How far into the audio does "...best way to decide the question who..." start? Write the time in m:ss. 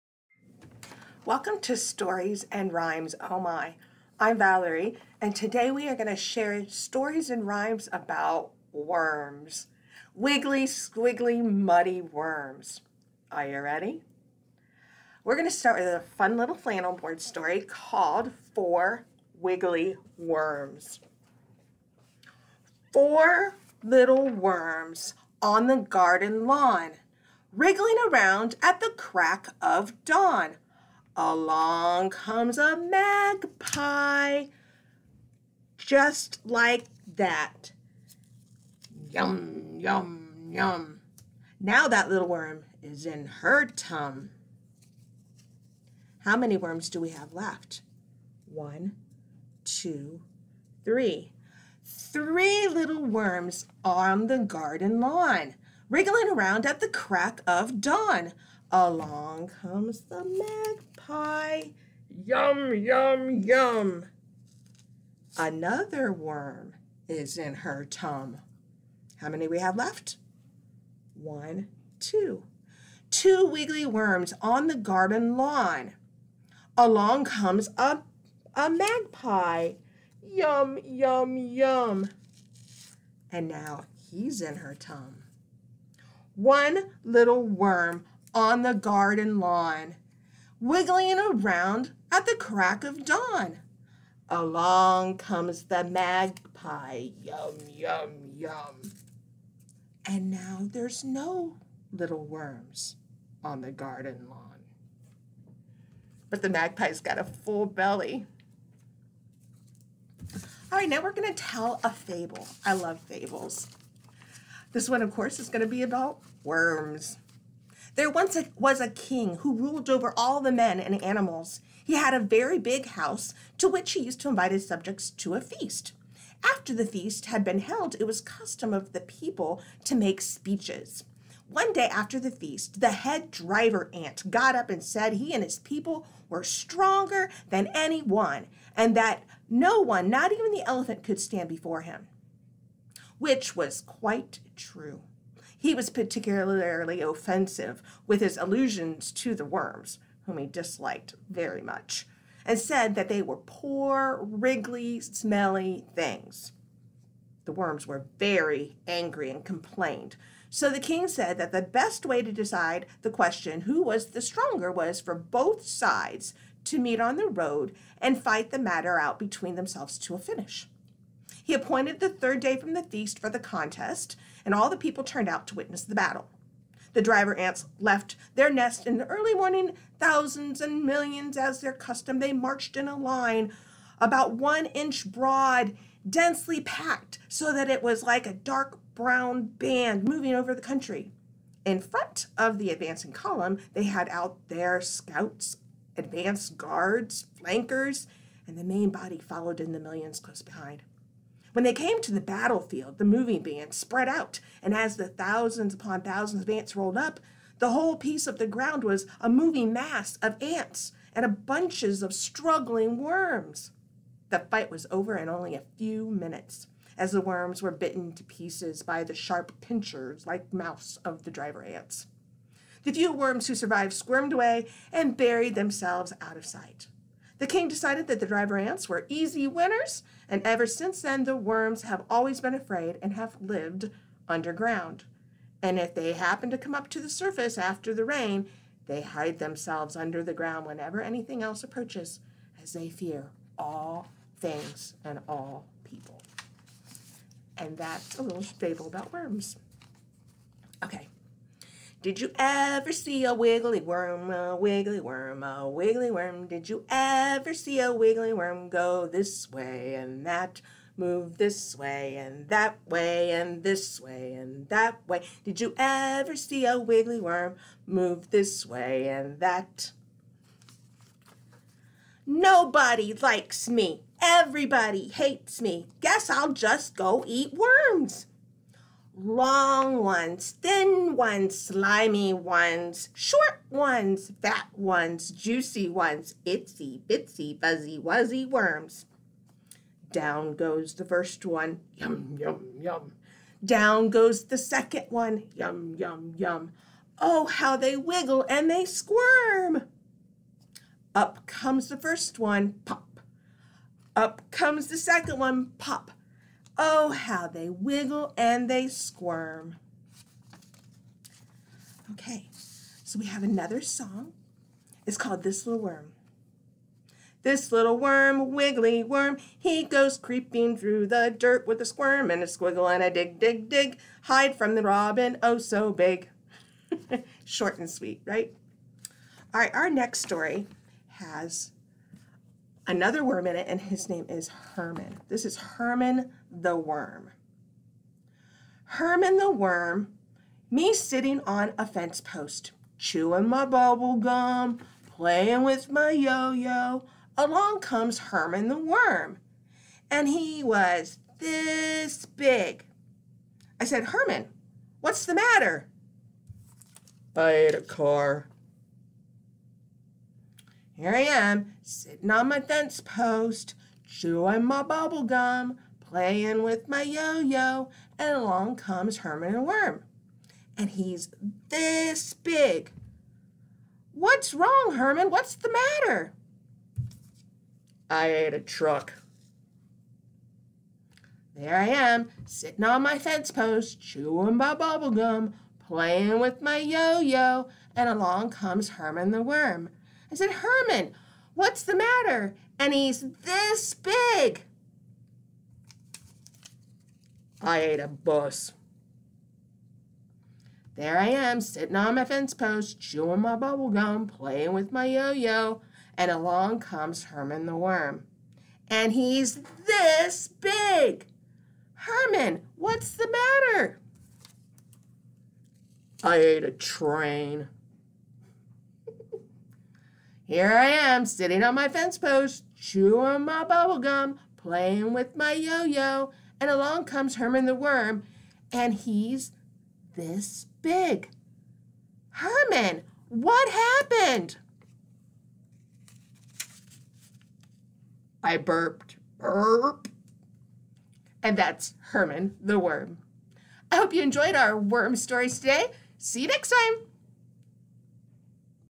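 2:41.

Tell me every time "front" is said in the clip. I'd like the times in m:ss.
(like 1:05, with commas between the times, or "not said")
3:11.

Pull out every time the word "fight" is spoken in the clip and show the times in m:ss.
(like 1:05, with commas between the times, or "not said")
2:48, 3:34.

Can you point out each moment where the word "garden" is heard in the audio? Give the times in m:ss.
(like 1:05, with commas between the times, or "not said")
0:25, 0:54, 1:14, 1:28, 1:43.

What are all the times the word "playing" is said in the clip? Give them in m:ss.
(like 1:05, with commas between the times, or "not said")
5:45, 6:05, 6:25, 6:44, 7:04.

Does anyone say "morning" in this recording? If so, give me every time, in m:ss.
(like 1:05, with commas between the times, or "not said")
2:59.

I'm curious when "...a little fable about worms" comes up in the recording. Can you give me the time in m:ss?
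4:08.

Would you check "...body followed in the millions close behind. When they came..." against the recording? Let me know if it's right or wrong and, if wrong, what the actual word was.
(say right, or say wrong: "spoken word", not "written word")
right.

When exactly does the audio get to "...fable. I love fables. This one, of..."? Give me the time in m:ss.
1:51.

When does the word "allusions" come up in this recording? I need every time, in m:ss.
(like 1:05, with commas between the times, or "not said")
2:28.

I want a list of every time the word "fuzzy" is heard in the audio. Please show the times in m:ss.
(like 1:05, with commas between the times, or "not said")
4:47.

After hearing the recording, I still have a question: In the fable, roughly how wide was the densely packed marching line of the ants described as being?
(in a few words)
1 inch.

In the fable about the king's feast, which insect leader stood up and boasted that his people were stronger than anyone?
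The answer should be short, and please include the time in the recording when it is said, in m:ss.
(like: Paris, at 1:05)
Head driver ant, at 2:12.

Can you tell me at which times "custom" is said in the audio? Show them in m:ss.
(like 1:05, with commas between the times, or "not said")
2:08, 3:01.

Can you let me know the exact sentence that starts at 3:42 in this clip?
The few worms who survived squirmed away and buried themselves out of sight.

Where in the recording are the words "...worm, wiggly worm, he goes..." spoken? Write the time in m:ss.
5:17.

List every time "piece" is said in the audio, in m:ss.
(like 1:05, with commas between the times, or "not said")
3:27, 3:38.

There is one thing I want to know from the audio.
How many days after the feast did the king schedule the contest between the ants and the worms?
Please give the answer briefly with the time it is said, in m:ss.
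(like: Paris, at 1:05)
Third day, at 2:52.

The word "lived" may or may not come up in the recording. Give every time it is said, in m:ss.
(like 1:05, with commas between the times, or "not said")
3:53.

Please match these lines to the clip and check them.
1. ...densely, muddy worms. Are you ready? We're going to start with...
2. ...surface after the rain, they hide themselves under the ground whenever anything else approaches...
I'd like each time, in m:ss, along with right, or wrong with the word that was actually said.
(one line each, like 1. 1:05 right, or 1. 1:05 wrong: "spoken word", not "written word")
1. 0:10 wrong: "squiggly", not "densely"
2. 3:57 right.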